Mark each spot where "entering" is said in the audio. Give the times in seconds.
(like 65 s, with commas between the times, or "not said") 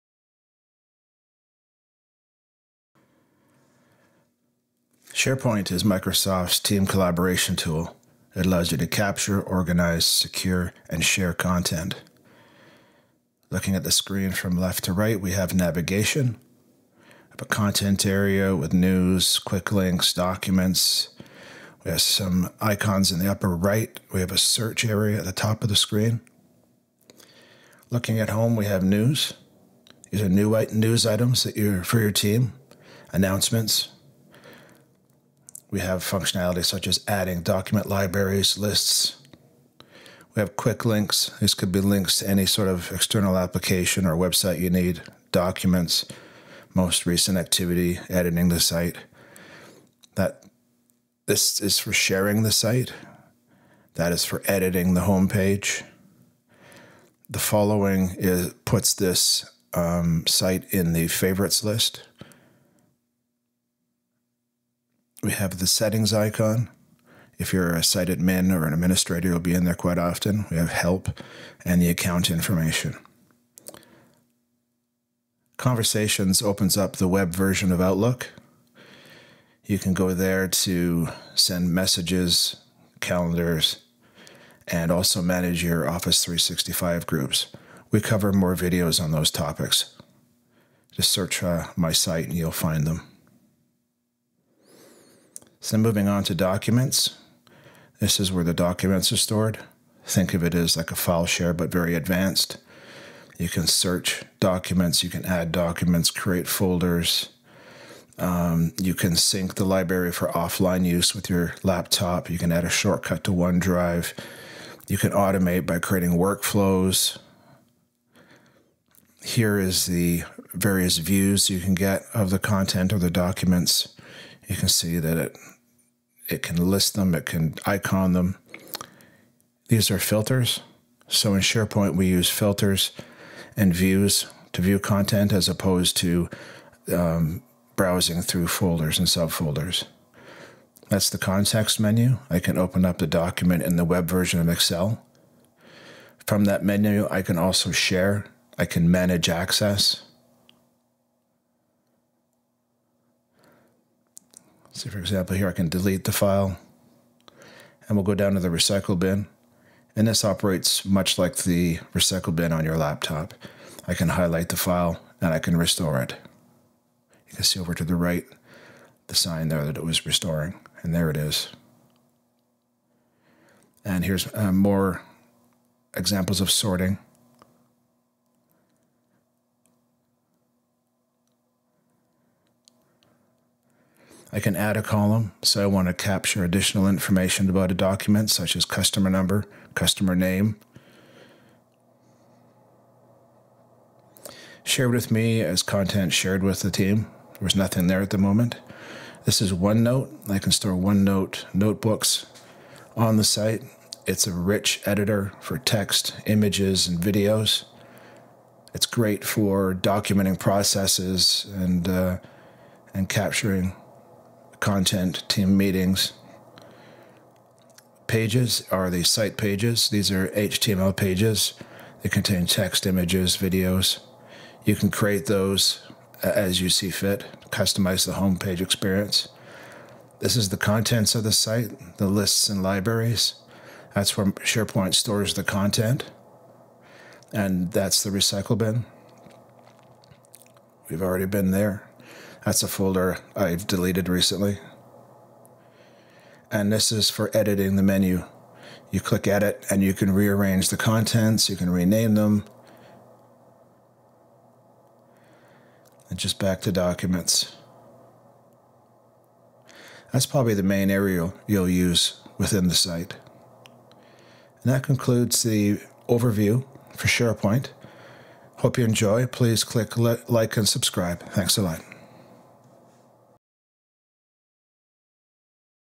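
not said.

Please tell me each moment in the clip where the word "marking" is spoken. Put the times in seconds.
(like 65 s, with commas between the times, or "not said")
not said.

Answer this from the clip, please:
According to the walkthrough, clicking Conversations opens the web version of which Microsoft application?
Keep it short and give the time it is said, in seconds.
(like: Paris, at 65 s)
Outlook, at 77 s.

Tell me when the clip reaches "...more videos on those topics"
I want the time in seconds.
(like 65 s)
88 s.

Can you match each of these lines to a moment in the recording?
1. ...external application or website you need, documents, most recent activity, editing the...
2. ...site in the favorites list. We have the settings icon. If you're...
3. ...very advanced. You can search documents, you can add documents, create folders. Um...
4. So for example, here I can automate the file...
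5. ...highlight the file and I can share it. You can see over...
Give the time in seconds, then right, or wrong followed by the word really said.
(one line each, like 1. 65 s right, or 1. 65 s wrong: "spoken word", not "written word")
1. 42 s right
2. 60 s right
3. 101 s right
4. 154 s wrong: "delete", not "automate"
5. 164 s wrong: "restore", not "share".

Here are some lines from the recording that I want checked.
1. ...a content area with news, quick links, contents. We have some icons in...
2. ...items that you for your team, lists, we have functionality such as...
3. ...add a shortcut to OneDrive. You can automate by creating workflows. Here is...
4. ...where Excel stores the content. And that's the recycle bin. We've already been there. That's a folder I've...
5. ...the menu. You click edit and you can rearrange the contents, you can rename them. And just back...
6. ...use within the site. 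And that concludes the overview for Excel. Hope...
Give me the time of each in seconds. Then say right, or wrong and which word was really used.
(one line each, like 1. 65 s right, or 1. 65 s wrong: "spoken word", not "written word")
1. 17 s wrong: "documents", not "contents"
2. 31 s wrong: "announcements", not "lists"
3. 112 s right
4. 234 s wrong: "SharePoint", not "Excel"
5. 247 s right
6. 261 s wrong: "SharePoint", not "Excel".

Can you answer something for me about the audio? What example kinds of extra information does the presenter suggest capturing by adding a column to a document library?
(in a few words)
customer number, customer name.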